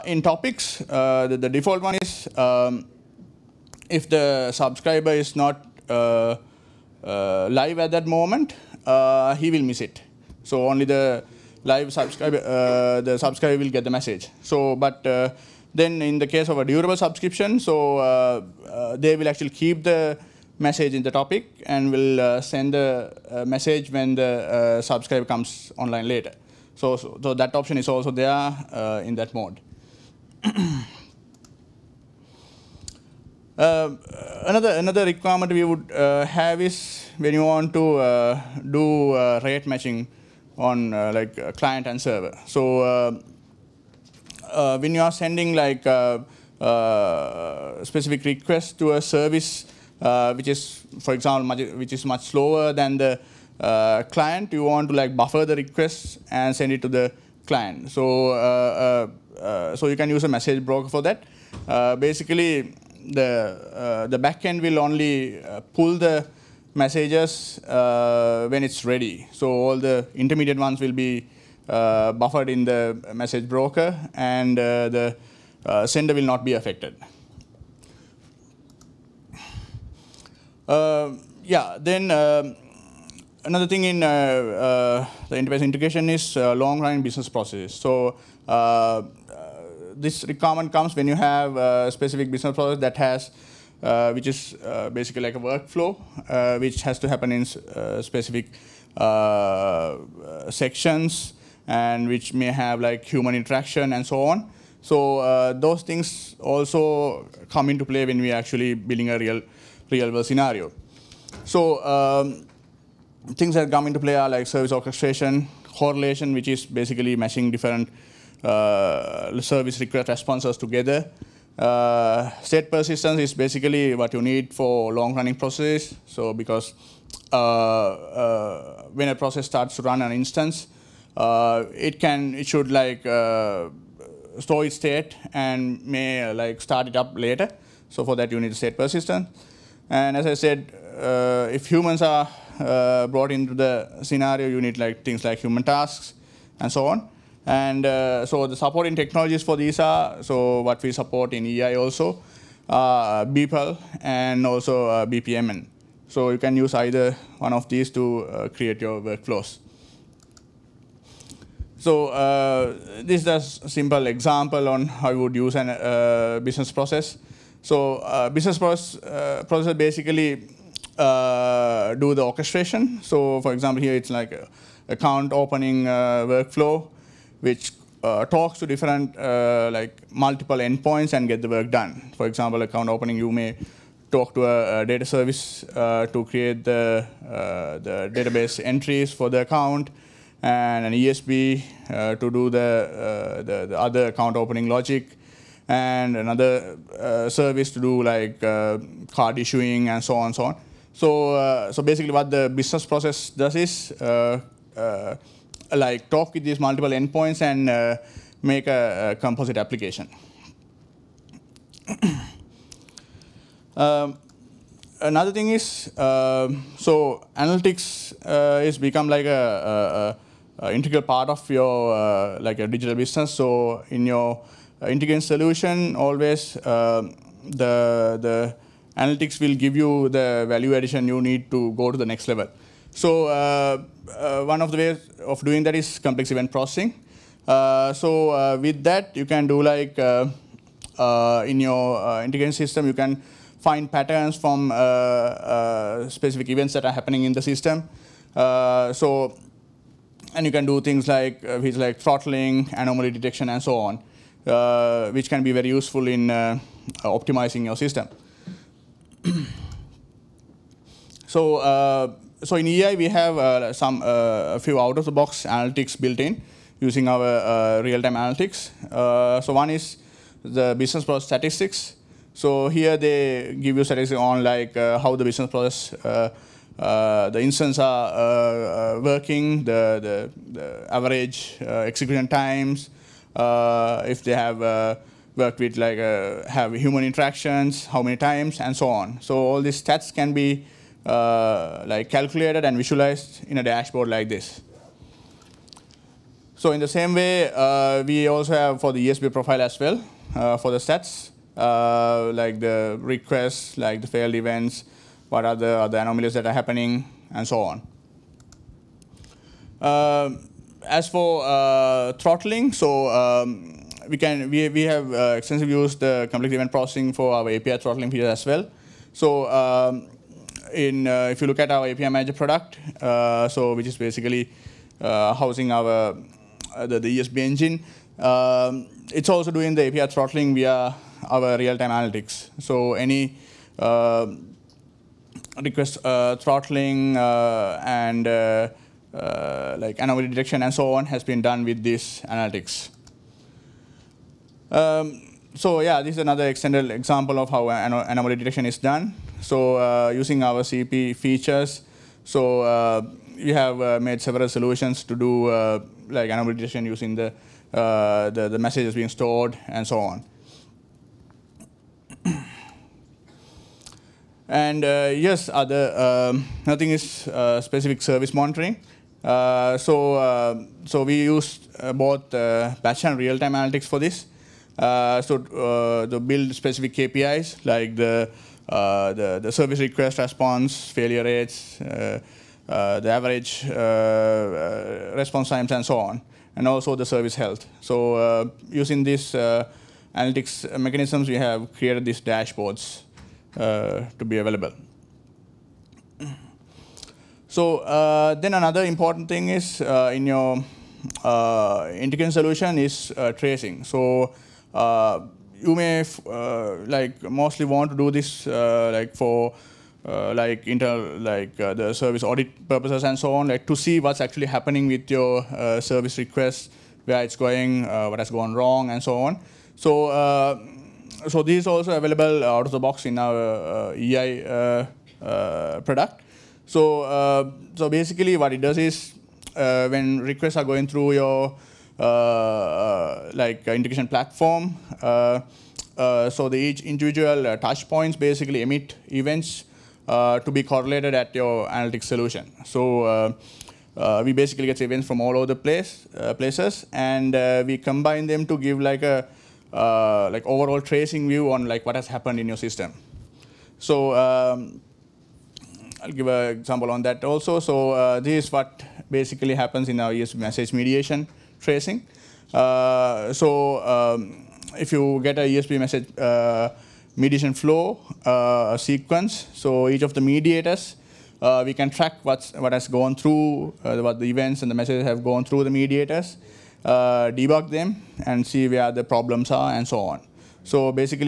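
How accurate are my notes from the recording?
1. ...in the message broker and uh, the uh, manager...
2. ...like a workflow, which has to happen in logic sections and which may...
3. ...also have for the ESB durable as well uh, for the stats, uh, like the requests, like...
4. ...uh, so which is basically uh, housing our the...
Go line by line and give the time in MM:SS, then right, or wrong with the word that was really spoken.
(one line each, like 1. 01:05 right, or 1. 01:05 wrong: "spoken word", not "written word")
1. 01:12 wrong: "sender", not "manager"
2. 01:35 wrong: "specific", not "logic"
3. 04:58 wrong: "profile", not "durable"
4. 05:23 right.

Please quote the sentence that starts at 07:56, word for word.
Uh, debug them and see where the problems are and so on.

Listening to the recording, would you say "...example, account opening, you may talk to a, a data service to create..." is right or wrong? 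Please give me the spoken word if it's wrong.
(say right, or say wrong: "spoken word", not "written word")
right.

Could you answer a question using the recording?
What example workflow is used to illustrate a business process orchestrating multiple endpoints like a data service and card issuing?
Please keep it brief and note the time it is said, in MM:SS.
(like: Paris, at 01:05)
Account opening workflow, at 02:54.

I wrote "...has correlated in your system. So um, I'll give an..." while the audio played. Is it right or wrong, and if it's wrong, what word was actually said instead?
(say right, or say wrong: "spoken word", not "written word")
wrong: "happened", not "correlated".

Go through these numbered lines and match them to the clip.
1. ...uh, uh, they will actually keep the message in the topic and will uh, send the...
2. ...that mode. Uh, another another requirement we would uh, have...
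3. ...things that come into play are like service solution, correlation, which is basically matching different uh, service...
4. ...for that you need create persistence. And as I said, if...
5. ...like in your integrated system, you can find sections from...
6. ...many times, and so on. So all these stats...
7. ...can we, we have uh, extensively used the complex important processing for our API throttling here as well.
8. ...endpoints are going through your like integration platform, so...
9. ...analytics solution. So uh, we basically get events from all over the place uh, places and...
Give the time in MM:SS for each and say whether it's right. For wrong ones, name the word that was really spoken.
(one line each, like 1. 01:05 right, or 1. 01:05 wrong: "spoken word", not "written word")
1. 00:17 right
2. 00:29 right
3. 01:53 wrong: "orchestration", not "solution"
4. 02:18 wrong: "state", not "create"
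5. 03:59 wrong: "patterns", not "sections"
6. 04:48 right
7. 05:14 wrong: "event", not "important"
8. 07:10 wrong: "requests", not "endpoints"
9. 07:21 right.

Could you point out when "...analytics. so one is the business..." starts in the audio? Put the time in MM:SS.
04:28.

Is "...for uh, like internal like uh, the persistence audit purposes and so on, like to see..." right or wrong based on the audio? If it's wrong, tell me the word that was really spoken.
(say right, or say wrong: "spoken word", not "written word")
wrong: "service", not "persistence".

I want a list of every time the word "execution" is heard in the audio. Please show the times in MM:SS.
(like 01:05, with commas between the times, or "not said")
04:41.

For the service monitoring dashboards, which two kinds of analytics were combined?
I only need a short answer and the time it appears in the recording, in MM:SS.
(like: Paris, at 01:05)
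Batch and real-time, at 06:12.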